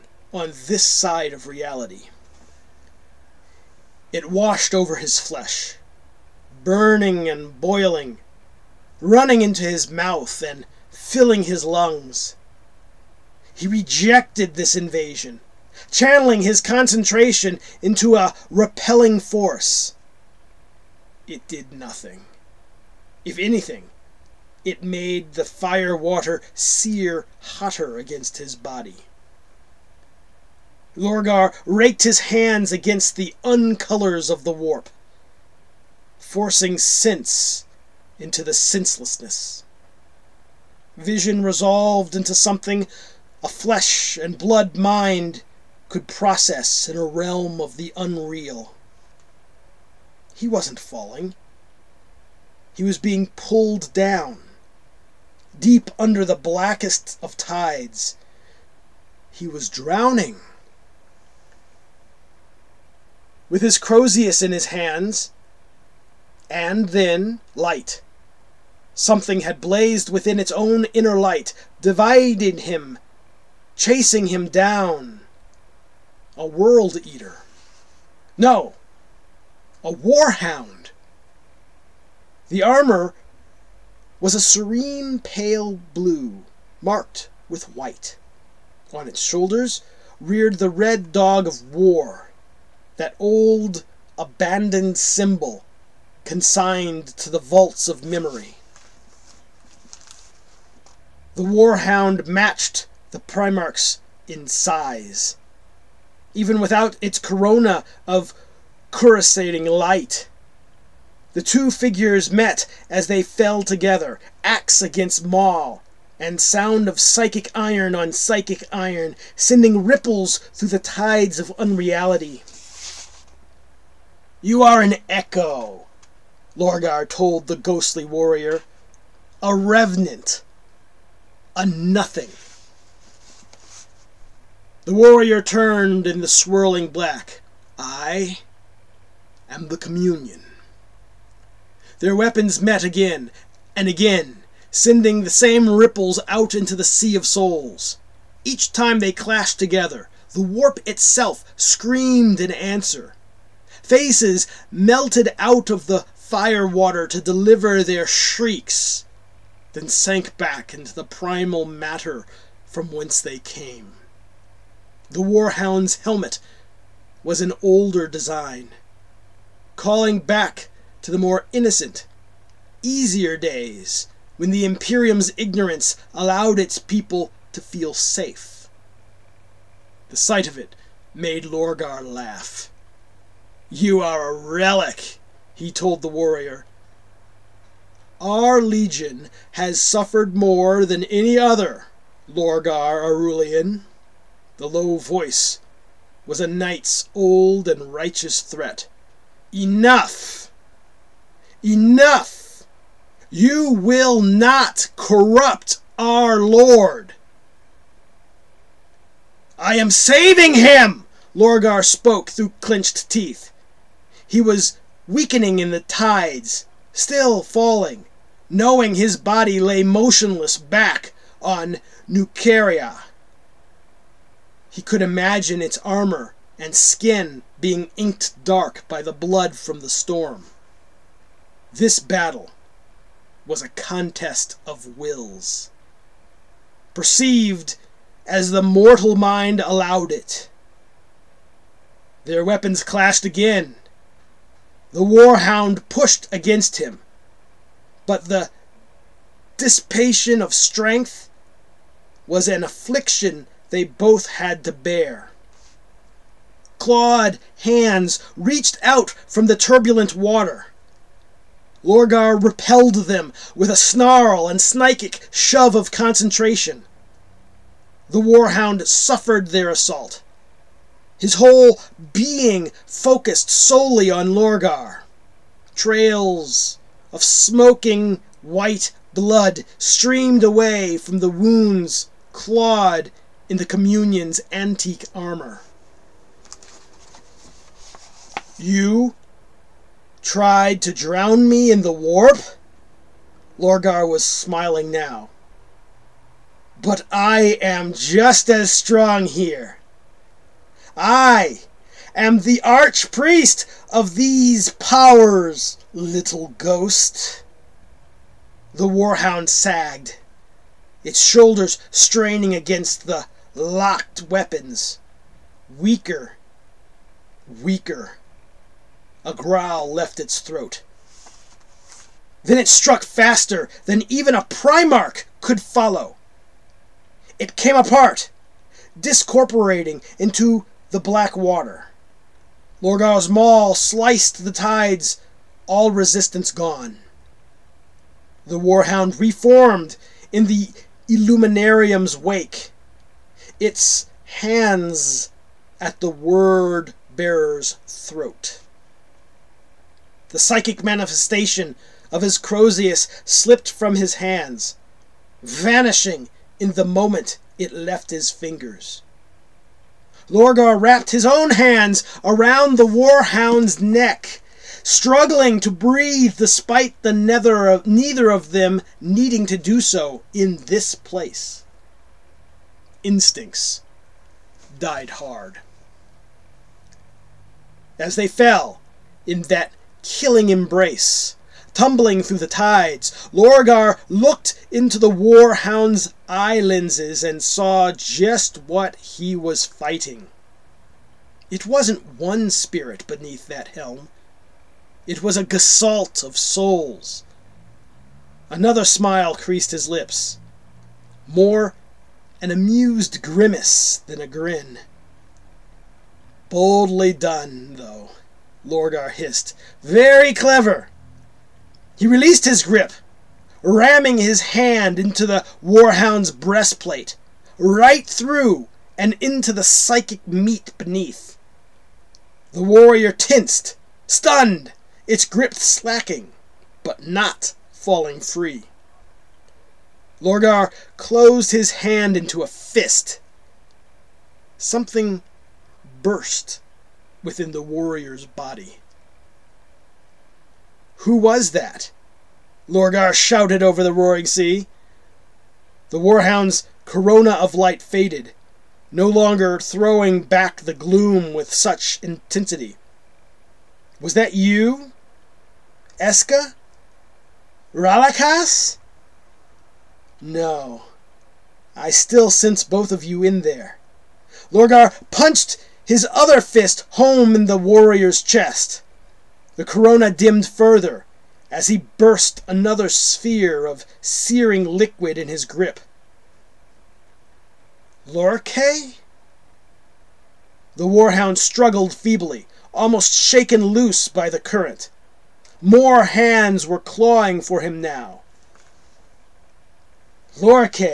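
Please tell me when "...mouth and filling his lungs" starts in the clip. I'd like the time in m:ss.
0:09.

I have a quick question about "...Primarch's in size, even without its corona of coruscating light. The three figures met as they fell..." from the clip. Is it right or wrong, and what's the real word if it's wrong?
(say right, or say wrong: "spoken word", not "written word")
wrong: "two", not "three".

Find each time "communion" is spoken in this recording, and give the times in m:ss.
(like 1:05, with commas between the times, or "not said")
2:19, 4:43.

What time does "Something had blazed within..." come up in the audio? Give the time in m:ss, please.
1:08.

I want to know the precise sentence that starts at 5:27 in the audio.
It came apart, discorporating into the black water.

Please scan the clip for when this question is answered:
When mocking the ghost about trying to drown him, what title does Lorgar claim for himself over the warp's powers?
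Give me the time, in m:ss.
5:02.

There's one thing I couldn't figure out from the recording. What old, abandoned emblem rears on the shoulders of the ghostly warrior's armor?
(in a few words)
the red dog of war.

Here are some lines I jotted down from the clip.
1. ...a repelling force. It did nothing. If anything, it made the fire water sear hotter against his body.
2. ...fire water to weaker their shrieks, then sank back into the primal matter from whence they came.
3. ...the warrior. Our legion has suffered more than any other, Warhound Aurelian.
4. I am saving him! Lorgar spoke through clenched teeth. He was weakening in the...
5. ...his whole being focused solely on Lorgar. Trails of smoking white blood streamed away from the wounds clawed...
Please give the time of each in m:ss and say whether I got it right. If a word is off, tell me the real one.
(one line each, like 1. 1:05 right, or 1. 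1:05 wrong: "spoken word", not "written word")
1. 0:18 right
2. 2:36 wrong: "deliver", not "weaker"
3. 3:06 wrong: "Lorgar", not "Warhound"
4. 3:29 right
5. 4:31 right.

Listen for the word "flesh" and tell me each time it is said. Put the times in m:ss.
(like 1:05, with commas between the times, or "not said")
0:05, 0:43.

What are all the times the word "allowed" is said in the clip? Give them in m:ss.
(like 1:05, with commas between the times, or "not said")
2:56, 3:59.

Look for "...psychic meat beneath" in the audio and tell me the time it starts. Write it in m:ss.
6:59.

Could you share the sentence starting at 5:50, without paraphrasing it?
The psychic manifestation of his crozius slipped from his hands, vanishing in the moment it left his fingers.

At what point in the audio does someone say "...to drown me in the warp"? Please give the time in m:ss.
4:50.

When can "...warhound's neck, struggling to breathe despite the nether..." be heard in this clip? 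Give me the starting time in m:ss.
6:02.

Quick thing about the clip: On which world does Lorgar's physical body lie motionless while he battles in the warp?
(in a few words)
Nuceria.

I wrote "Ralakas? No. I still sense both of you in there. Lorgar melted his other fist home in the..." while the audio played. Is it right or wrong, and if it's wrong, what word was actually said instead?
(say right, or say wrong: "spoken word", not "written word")
wrong: "punched", not "melted".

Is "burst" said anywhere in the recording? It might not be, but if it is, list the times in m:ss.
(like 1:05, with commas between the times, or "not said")
7:16, 7:51.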